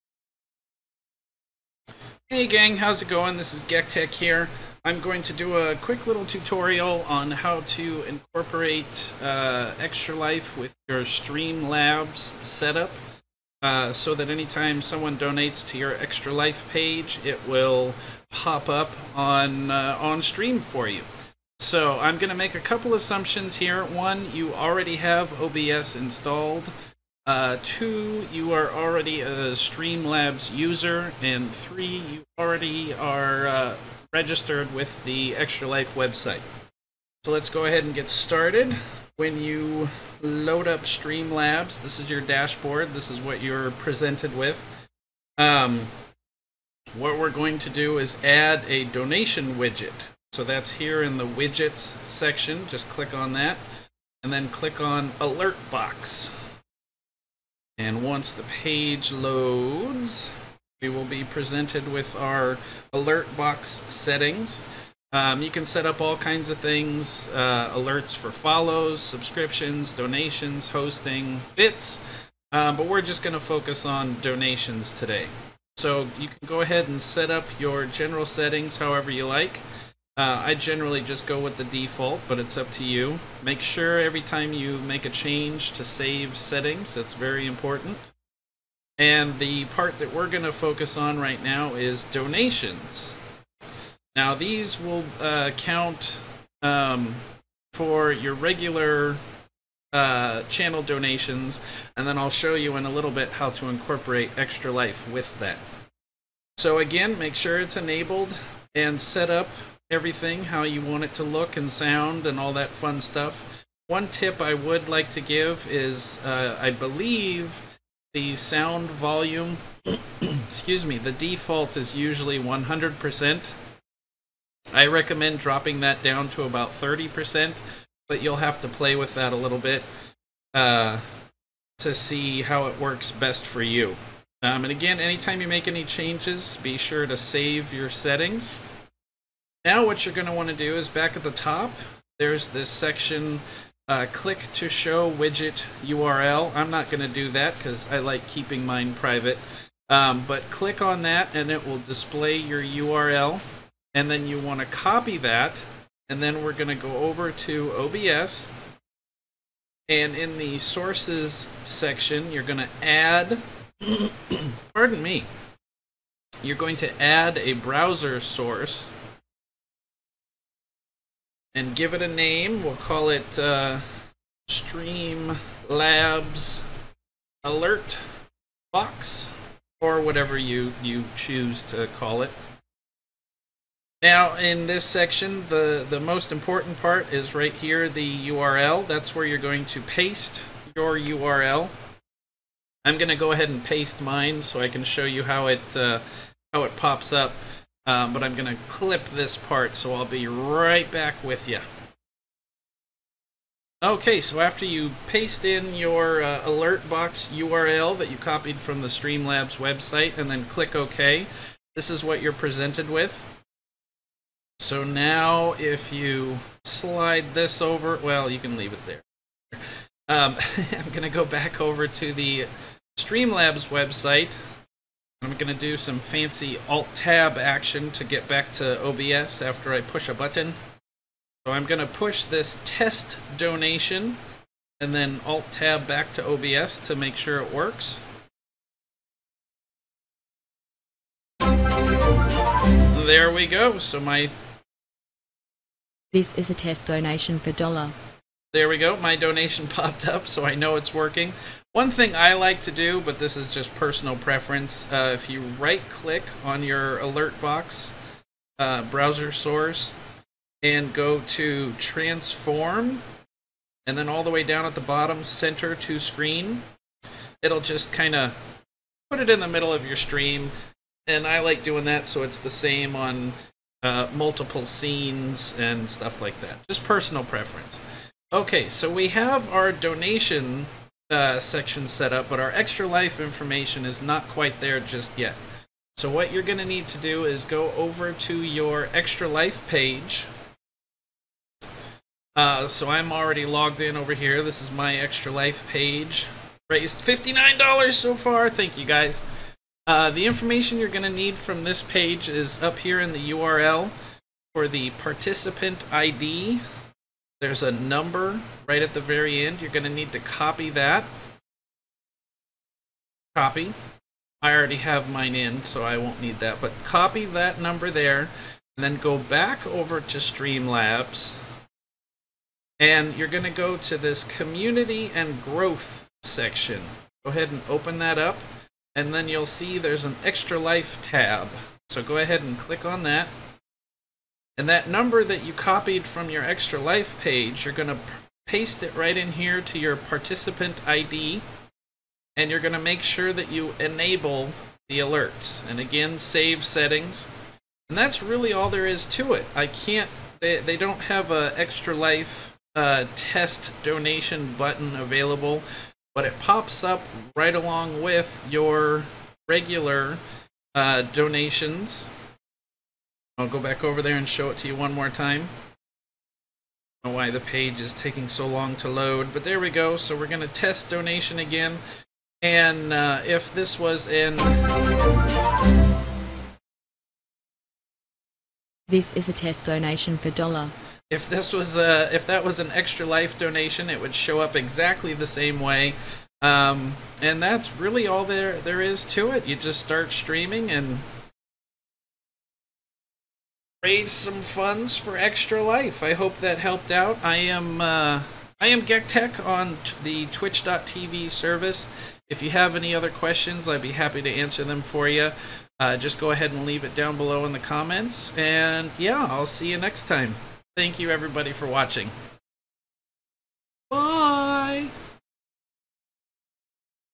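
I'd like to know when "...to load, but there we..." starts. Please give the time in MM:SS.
06:08.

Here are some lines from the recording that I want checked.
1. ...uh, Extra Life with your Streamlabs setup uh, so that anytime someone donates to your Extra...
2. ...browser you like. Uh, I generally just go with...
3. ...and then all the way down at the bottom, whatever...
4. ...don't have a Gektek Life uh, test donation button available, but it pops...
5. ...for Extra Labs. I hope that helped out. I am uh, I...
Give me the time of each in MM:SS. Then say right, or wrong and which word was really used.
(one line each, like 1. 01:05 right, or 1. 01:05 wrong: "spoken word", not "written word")
1. 00:09 right
2. 01:18 wrong: "however", not "browser"
3. 04:23 wrong: "center", not "whatever"
4. 05:50 wrong: "Extra", not "Gektek"
5. 06:34 wrong: "Life", not "Labs".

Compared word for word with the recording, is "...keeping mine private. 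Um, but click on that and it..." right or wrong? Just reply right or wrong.
right.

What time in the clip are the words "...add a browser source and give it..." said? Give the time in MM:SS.
02:47.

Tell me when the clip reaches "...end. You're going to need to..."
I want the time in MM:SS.
05:09.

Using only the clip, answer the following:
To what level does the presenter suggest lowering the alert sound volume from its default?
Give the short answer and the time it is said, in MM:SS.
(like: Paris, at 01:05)
30%, at 02:06.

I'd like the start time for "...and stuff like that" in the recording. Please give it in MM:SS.
04:35.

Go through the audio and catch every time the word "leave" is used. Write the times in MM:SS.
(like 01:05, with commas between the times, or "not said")
03:38, 06:46.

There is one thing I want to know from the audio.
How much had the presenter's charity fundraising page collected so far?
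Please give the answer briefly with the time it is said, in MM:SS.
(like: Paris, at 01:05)
$59, at 04:56.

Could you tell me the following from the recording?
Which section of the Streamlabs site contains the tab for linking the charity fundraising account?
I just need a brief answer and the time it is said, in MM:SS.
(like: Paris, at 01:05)
Community and Growth, at 05:24.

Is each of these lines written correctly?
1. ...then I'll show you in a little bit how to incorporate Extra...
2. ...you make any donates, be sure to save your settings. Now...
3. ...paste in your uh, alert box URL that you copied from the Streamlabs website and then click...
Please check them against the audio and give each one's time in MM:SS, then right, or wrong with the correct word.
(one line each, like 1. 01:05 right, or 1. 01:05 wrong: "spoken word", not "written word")
1. 01:42 right
2. 02:15 wrong: "changes", not "donates"
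3. 03:25 right.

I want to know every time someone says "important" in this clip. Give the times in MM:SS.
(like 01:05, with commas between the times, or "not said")
01:27, 03:06.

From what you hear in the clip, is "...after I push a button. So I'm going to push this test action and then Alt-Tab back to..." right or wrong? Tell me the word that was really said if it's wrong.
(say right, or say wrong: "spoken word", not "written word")
wrong: "donation", not "action".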